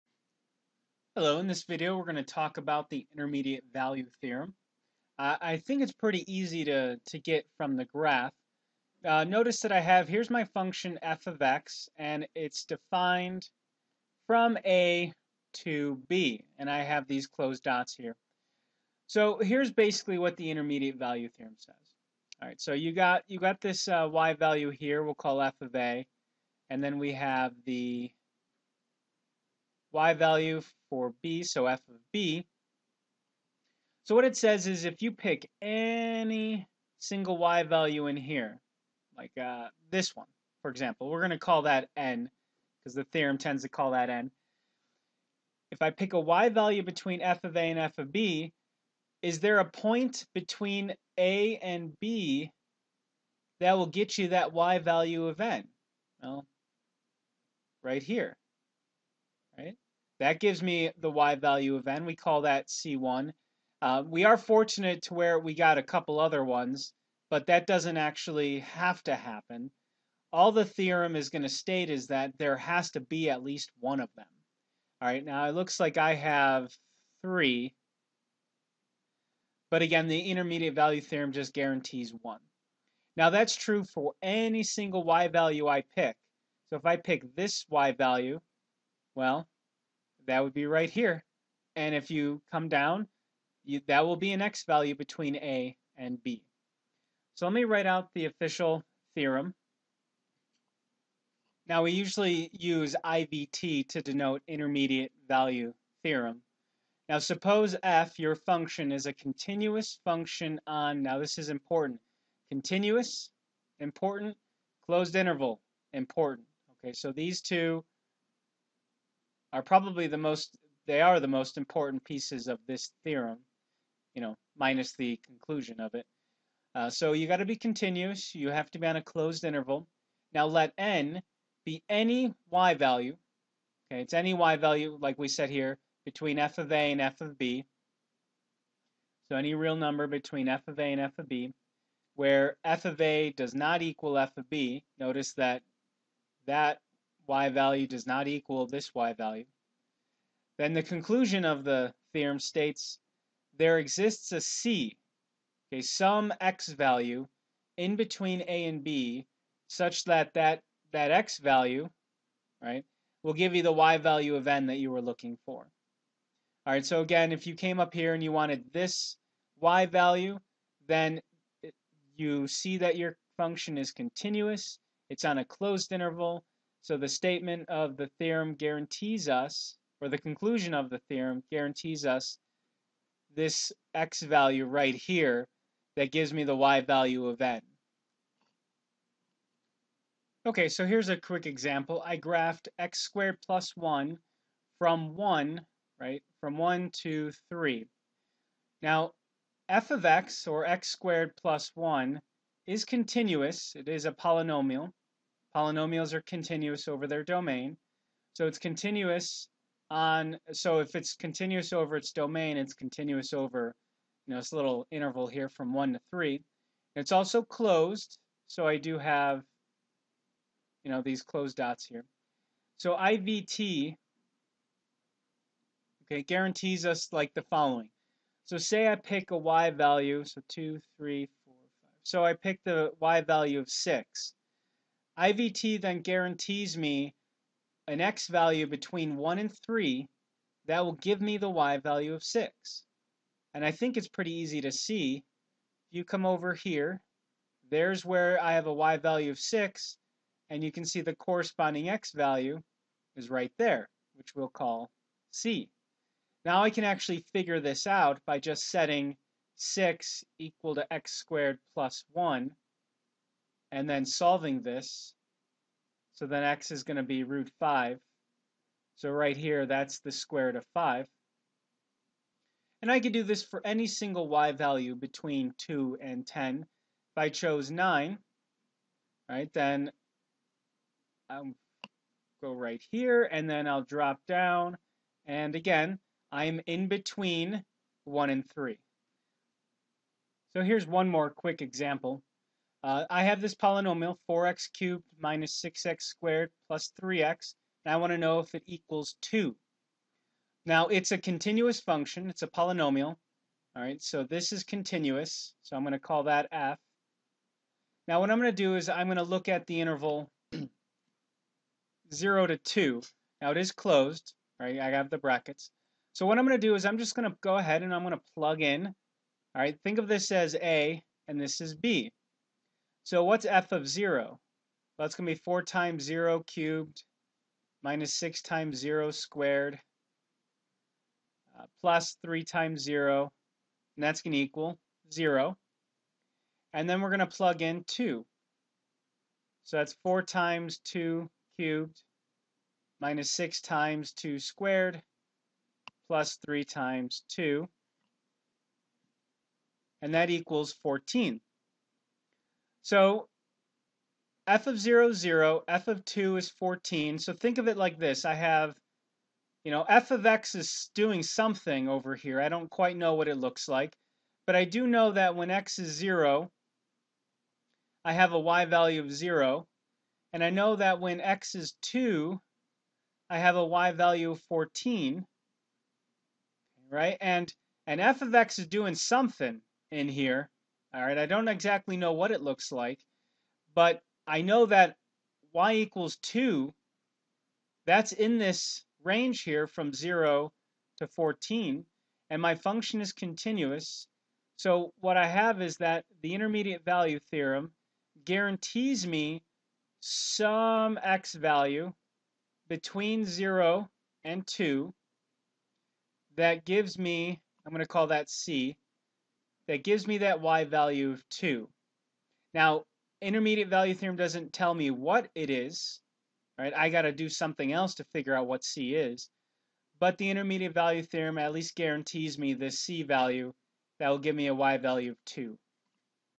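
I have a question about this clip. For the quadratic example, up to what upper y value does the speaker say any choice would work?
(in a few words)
10.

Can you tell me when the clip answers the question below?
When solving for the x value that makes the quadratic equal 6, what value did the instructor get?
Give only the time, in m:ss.
4:29.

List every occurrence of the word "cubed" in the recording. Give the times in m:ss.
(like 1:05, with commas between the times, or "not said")
4:54, 5:26, 5:41.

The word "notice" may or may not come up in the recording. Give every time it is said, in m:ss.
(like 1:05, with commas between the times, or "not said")
0:09, 2:24.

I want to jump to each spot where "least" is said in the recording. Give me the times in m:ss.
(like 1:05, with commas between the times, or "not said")
1:13, 7:01.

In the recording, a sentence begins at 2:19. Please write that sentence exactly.
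So any real number between f of a and f of b, where f of a does not equal f of b.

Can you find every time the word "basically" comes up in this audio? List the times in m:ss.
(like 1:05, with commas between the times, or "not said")
0:19.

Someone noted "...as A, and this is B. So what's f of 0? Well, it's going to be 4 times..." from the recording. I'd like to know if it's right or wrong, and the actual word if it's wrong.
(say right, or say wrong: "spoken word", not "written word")
right.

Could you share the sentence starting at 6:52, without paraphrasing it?
Now, intermediate value theorem doesn't tell me what it is, right?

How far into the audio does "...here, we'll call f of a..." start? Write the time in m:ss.
0:24.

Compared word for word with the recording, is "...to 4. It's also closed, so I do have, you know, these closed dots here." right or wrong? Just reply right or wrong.
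wrong.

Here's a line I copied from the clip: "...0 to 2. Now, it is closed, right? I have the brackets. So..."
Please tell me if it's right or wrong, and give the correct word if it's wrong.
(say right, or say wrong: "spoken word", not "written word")
right.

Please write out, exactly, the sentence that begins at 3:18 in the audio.
Now, f of x, or x squared plus 1, is continuous.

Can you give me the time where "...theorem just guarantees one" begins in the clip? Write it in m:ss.
1:21.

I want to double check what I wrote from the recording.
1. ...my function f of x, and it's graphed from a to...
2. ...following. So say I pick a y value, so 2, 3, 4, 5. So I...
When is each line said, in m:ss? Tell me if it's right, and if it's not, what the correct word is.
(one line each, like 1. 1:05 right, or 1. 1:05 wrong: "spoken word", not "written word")
1. 0:10 wrong: "defined", not "graphed"
2. 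3:47 right.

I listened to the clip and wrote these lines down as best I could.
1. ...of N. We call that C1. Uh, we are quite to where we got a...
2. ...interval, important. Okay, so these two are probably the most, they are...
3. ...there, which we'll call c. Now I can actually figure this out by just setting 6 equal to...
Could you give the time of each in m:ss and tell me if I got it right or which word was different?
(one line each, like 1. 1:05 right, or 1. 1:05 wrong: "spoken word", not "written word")
1. 1:01 wrong: "fortunate", not "quite"
2. 1:55 right
3. 4:13 right.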